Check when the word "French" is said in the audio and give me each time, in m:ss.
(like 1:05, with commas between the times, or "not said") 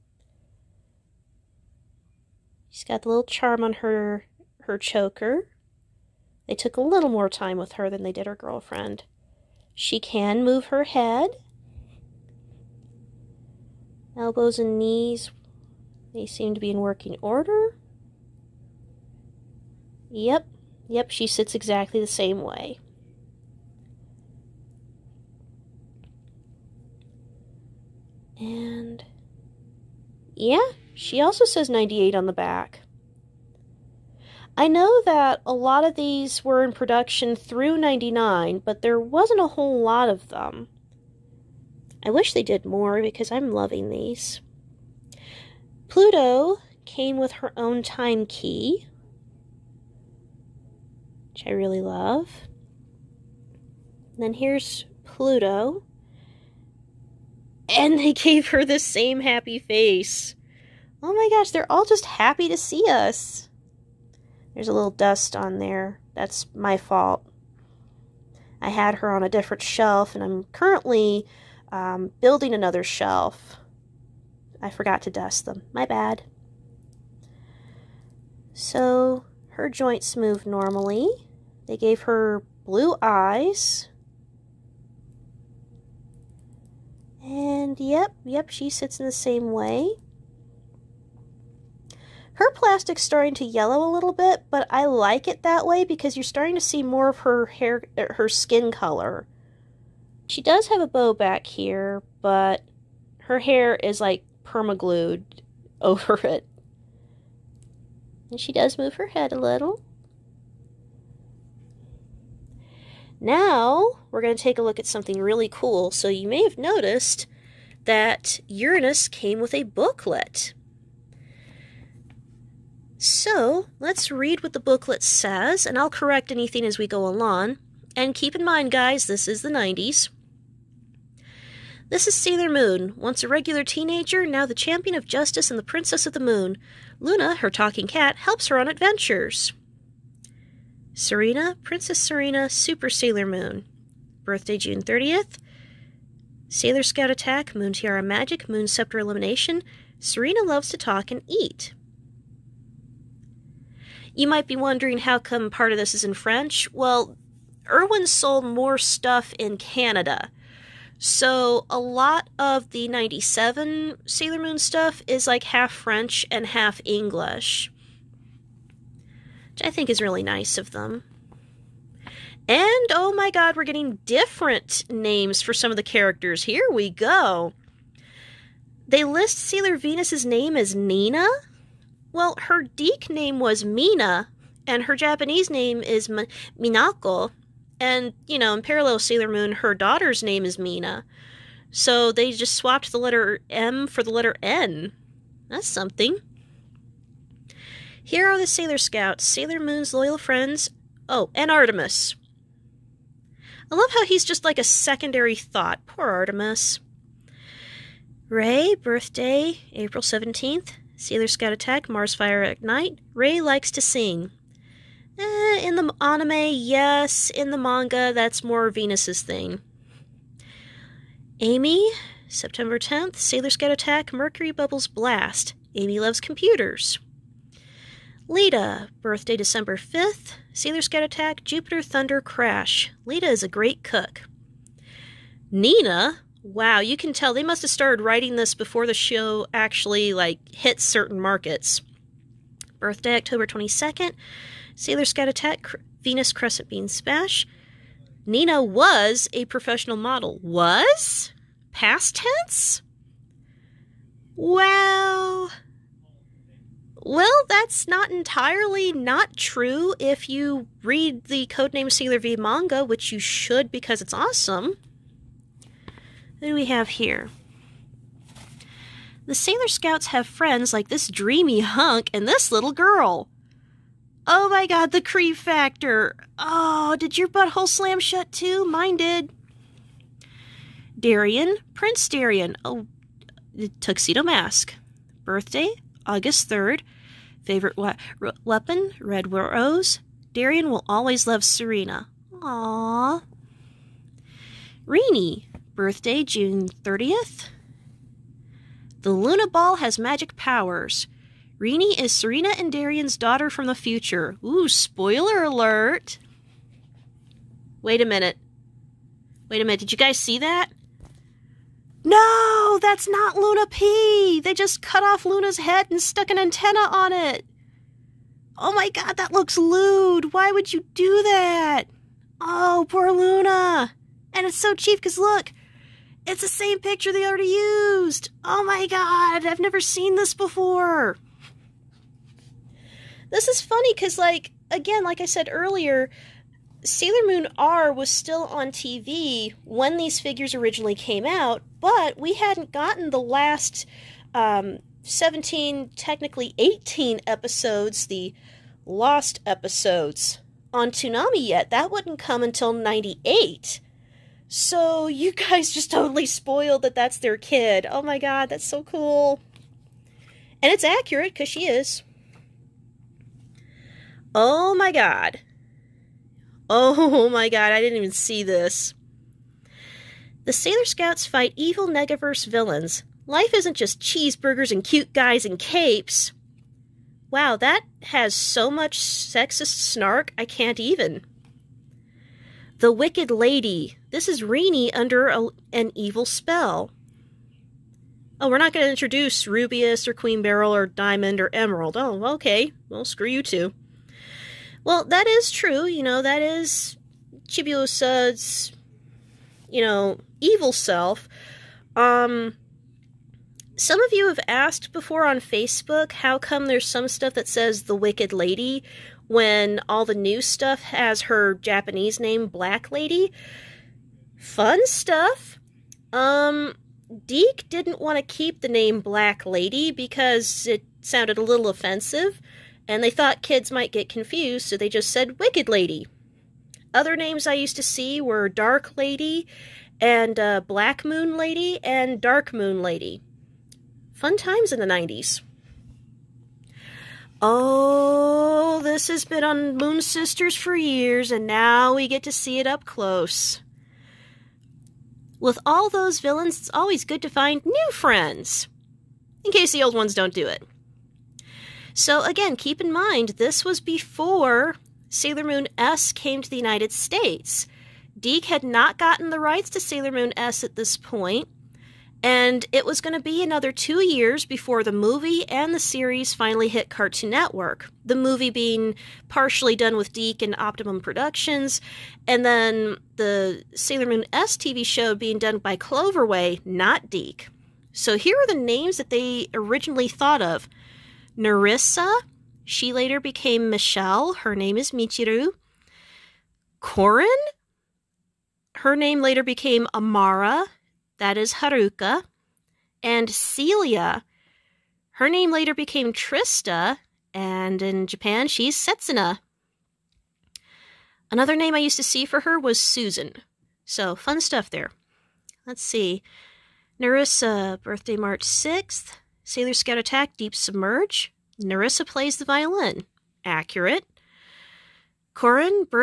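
2:36, 2:45.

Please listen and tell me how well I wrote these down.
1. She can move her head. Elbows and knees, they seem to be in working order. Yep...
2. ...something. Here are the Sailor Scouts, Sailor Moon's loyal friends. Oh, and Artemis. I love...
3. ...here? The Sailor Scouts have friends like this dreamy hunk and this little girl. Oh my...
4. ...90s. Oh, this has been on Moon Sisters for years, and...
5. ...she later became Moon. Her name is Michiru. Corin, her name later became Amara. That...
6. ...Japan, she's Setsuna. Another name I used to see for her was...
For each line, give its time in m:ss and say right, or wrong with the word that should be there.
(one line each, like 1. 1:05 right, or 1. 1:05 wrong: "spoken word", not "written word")
1. 0:09 right
2. 3:15 right
3. 4:26 right
4. 7:14 right
5. 8:02 wrong: "Michelle", not "Moon"
6. 8:18 right.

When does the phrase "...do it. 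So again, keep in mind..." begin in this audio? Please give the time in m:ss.
7:30.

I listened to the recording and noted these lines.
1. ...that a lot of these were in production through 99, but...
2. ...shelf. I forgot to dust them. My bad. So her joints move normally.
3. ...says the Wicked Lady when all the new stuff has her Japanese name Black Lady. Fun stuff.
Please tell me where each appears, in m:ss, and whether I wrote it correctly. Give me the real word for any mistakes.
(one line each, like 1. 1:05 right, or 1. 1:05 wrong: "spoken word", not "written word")
1. 0:35 right
2. 1:12 right
3. 6:47 right.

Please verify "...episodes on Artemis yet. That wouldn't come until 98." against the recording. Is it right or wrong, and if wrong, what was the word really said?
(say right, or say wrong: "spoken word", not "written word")
wrong: "Toonami", not "Artemis".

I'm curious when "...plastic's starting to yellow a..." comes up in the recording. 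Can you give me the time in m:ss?
1:32.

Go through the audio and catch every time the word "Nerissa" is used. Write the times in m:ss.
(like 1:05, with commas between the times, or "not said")
8:01, 8:26, 8:31.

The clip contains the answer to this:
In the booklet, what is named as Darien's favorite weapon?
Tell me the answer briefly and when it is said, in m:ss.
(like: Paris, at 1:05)
Red rose, at 4:49.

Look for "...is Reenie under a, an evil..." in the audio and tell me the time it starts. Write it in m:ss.
6:24.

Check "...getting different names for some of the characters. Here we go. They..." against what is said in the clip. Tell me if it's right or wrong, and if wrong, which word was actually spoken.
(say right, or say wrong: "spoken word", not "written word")
right.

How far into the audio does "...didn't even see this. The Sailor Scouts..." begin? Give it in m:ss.
6:07.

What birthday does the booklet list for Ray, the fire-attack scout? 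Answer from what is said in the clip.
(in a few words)
April 17th.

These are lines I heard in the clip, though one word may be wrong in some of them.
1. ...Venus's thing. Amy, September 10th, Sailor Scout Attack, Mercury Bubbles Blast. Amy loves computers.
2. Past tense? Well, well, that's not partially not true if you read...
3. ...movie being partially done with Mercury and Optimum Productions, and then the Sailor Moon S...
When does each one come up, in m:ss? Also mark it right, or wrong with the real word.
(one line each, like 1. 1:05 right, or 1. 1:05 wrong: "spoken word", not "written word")
1. 3:38 right
2. 4:11 wrong: "entirely", not "partially"
3. 7:48 wrong: "DIC", not "Mercury".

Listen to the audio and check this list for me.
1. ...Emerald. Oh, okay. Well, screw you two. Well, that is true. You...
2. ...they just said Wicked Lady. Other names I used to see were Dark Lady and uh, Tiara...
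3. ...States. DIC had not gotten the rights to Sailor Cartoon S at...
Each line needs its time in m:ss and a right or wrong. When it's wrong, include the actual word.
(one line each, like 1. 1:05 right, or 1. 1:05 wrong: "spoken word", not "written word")
1. 6:31 right
2. 7:04 wrong: "Black", not "Tiara"
3. 7:36 wrong: "Moon", not "Cartoon".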